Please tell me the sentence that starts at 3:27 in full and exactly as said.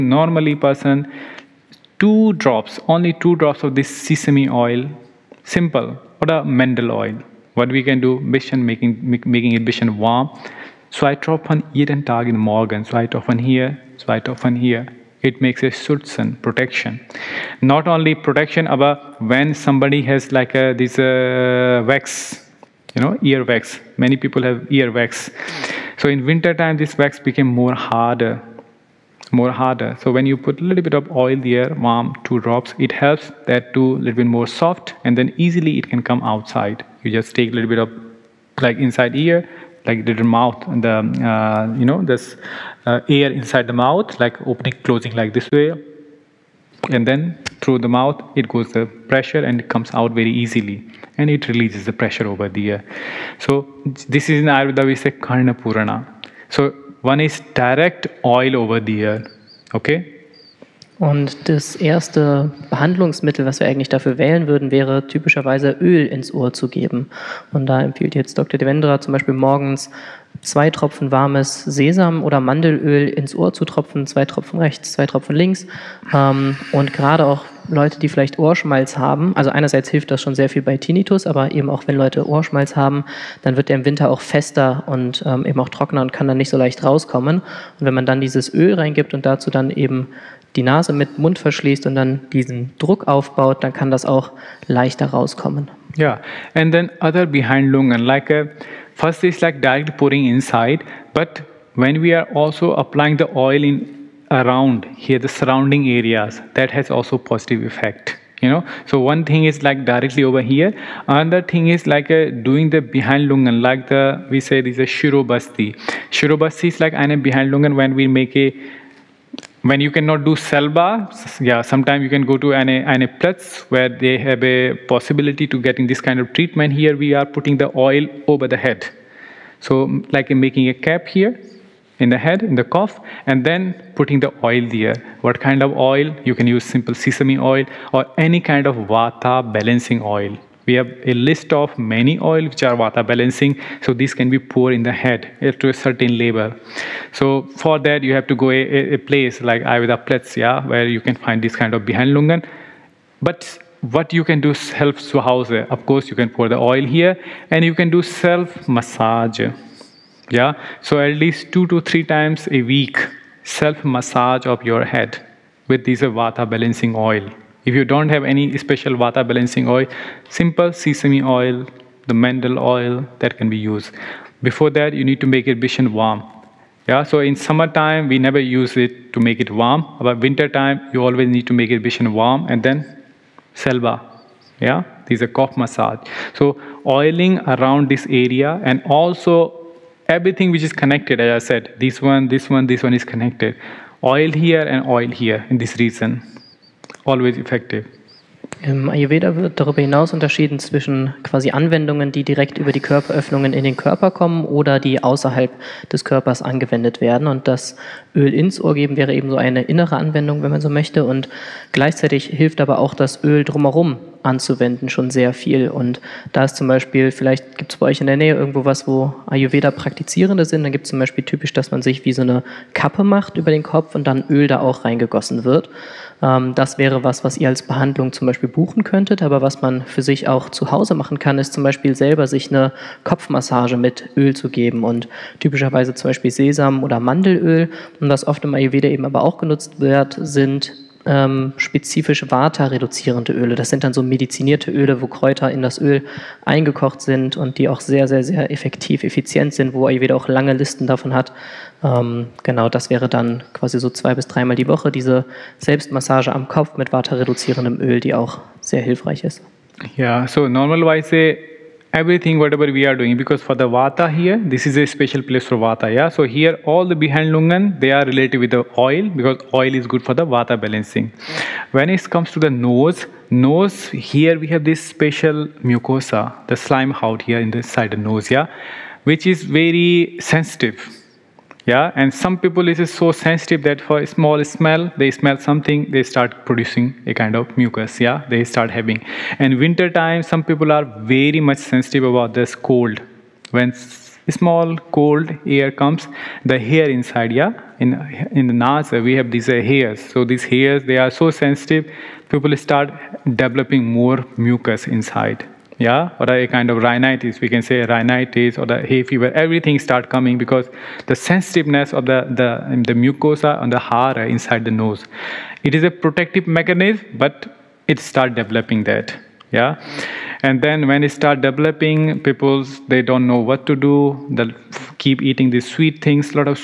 Und das Öl ins Ohr geben wäre eben so eine innere Anwendung, wenn man so möchte.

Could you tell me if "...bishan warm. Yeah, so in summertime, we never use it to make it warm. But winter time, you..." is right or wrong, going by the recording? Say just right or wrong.
right.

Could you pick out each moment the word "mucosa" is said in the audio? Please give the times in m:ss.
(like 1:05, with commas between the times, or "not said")
4:35, 5:13.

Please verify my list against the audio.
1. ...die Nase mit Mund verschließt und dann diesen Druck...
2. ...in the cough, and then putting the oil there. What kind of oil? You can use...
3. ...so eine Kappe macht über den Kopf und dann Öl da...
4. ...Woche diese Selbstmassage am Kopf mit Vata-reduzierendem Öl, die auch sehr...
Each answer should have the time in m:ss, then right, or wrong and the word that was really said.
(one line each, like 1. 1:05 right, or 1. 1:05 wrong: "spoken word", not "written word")
1. 1:30 right
2. 2:12 right
3. 3:42 right
4. 4:14 right.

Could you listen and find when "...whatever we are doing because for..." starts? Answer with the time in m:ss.
4:22.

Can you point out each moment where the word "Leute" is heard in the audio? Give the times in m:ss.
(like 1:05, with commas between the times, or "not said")
1:17, 1:21.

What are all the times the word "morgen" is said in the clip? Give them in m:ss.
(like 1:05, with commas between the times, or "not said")
0:12, 1:09.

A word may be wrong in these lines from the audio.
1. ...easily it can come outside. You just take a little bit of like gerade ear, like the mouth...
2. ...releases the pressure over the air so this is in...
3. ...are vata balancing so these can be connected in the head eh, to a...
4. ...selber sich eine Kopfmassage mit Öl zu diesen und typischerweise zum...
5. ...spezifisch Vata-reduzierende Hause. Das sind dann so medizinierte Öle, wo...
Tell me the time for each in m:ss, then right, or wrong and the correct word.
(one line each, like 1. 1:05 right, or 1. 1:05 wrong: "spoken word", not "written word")
1. 0:35 wrong: "inside", not "gerade"
2. 0:51 right
3. 2:22 wrong: "poured", not "connected"
4. 3:51 wrong: "geben", not "diesen"
5. 4:01 wrong: "Öle", not "Hause".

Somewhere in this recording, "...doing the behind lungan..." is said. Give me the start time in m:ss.
1:52.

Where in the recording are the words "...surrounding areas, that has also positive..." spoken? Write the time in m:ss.
1:45.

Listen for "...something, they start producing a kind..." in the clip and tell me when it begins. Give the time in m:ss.
4:45.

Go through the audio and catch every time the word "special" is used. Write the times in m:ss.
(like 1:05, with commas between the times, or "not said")
2:48, 4:24, 4:34.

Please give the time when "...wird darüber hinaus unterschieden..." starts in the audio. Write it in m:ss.
3:19.